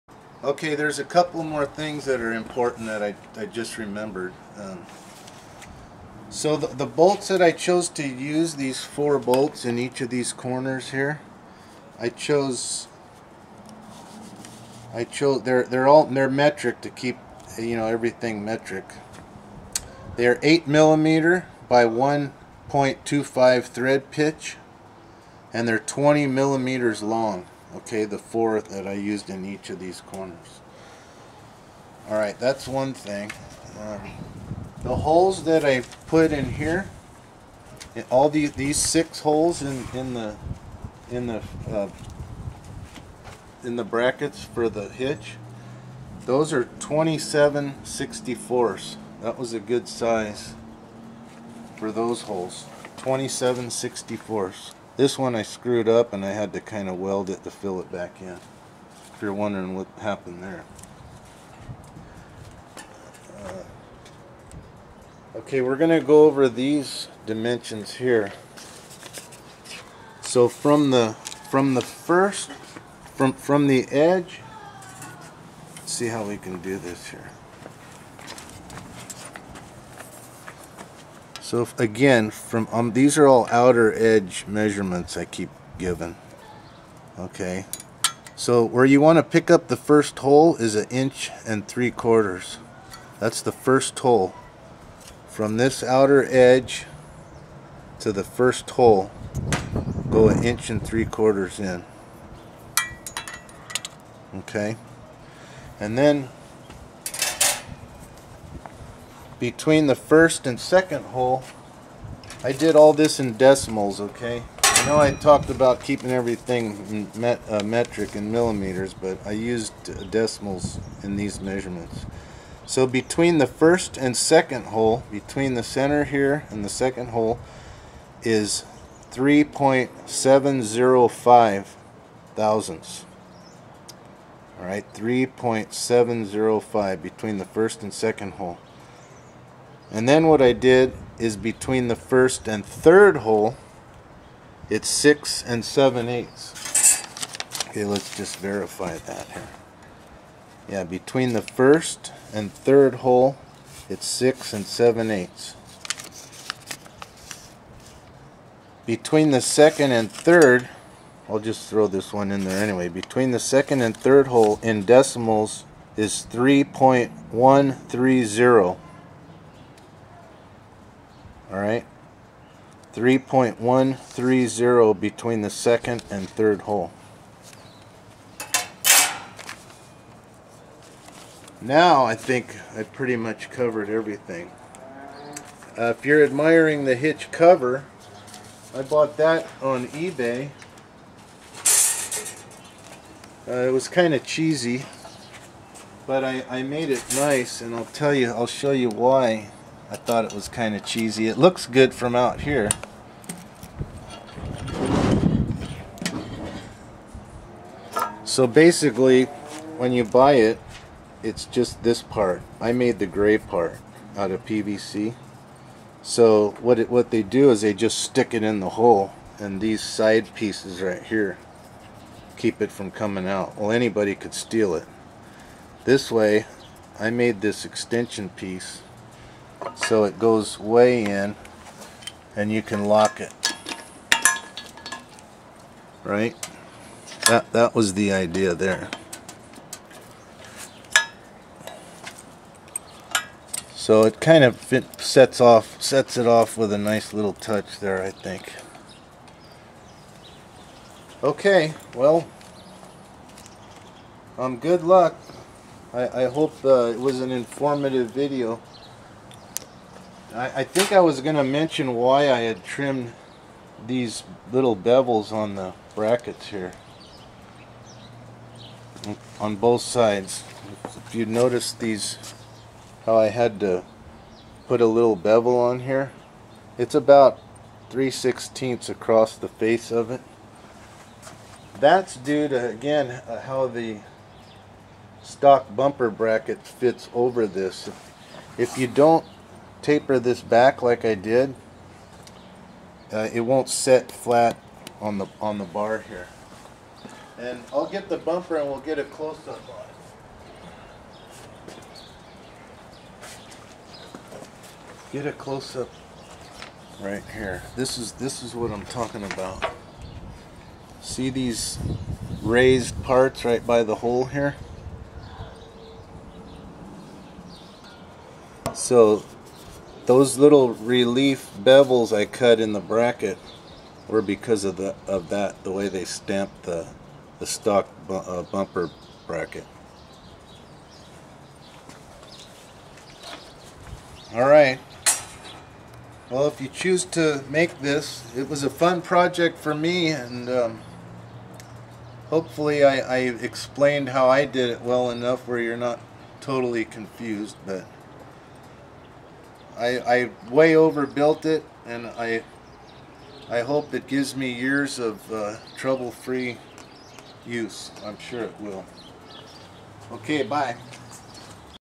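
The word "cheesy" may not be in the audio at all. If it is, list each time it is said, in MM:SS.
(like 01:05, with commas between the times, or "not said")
03:14, 03:20.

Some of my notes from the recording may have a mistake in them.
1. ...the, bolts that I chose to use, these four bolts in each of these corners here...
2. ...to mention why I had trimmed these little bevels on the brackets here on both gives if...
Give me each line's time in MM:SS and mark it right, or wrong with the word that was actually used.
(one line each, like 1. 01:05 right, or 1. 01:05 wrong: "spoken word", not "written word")
1. 00:06 right
2. 04:21 wrong: "sides", not "gives".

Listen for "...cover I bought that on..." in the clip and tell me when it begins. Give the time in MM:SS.
03:07.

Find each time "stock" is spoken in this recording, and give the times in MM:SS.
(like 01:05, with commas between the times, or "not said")
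04:45, 05:27.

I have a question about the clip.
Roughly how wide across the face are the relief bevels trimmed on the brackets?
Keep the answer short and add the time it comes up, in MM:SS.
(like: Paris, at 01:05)
3/16, at 04:37.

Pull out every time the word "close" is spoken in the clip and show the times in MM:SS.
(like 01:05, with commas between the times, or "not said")
04:59, 05:05.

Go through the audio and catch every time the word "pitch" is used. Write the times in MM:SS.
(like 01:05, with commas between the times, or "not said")
00:24.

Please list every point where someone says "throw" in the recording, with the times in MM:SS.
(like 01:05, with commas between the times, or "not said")
02:41.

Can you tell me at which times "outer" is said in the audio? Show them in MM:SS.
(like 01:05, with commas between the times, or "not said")
01:23, 01:35.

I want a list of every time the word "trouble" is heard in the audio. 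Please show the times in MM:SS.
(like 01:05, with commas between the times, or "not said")
05:55.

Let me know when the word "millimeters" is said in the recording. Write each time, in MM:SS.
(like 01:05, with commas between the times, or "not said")
00:20, 00:26, 01:58.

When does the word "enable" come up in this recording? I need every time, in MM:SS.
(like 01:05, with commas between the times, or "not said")
not said.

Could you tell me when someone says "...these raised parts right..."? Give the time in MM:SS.
05:11.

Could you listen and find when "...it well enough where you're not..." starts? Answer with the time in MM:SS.
05:44.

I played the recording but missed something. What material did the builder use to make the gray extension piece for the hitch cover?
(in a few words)
PVC.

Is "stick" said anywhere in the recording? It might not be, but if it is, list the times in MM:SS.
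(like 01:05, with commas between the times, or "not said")
03:37.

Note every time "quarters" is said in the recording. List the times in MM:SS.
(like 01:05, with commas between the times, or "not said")
01:31, 01:41.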